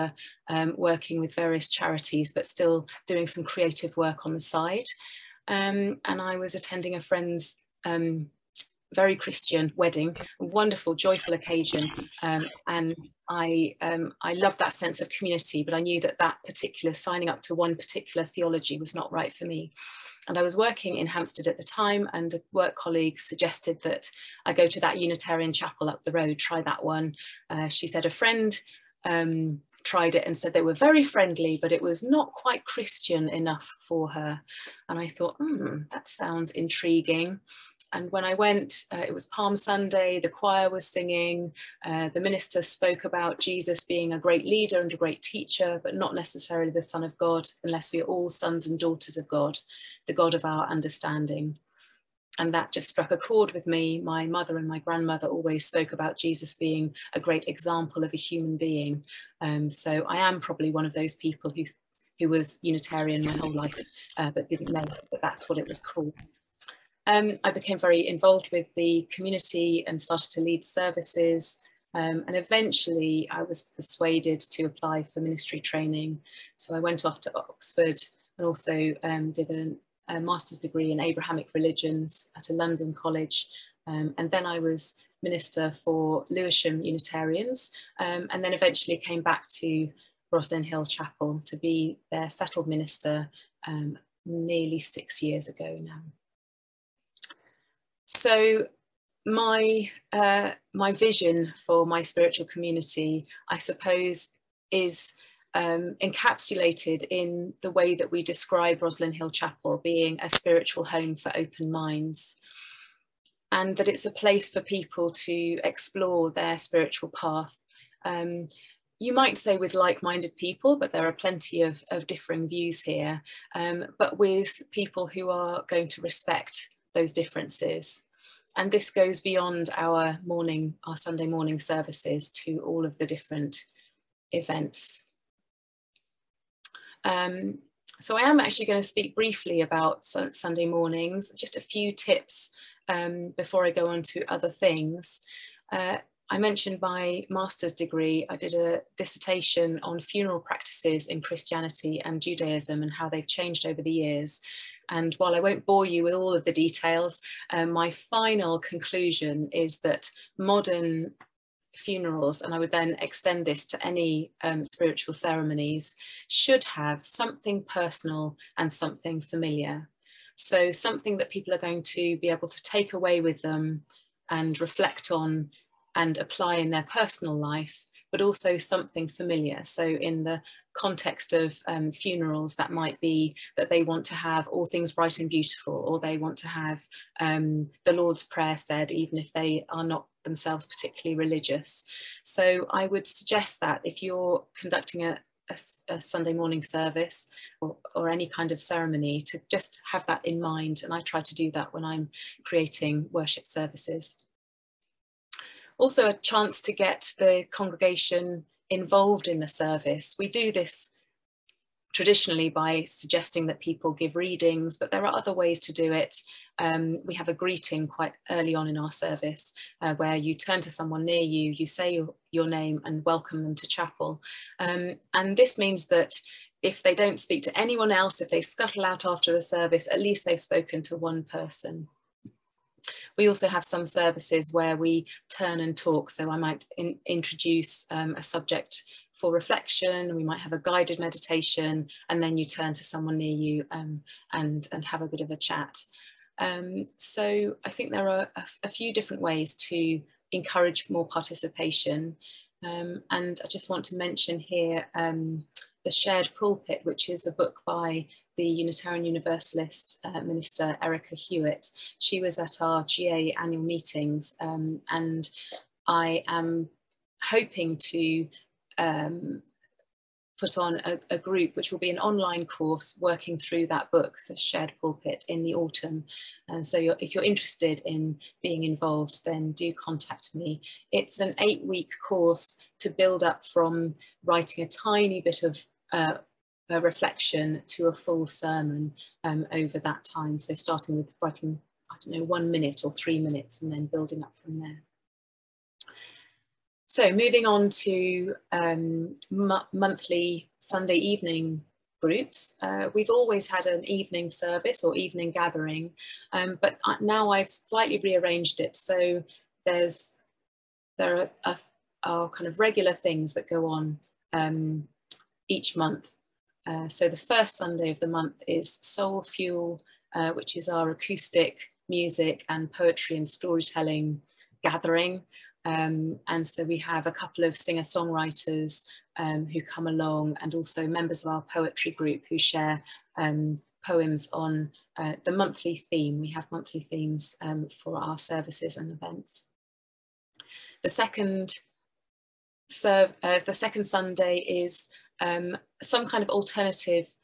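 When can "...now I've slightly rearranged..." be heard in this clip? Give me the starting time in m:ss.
5:07.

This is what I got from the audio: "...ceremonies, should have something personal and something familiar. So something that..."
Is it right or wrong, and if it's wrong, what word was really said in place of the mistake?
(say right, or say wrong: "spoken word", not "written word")
right.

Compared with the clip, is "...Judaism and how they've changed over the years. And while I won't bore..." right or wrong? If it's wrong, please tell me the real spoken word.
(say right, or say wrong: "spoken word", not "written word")
right.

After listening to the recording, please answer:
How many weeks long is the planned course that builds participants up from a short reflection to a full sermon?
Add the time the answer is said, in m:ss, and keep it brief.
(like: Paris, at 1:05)
8, at 4:41.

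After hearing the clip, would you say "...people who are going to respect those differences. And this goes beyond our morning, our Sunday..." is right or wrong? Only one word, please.
right.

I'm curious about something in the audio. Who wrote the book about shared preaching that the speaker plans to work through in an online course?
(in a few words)
Erika Hewitt.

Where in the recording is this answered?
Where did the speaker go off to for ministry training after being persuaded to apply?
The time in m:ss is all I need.
1:17.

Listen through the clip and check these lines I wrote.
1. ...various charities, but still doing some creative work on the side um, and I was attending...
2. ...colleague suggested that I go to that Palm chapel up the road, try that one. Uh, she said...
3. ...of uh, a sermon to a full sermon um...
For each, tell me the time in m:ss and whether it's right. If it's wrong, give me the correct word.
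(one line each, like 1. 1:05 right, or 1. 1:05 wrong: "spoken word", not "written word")
1. 0:01 right
2. 0:22 wrong: "Unitarian", not "Palm"
3. 4:45 wrong: "reflection", not "sermon".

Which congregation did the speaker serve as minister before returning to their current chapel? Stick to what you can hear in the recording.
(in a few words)
Lewisham Unitarians.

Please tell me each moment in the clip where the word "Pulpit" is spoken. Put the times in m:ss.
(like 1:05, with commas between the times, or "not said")
4:16, 4:34.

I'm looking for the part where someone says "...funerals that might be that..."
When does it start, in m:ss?
3:01.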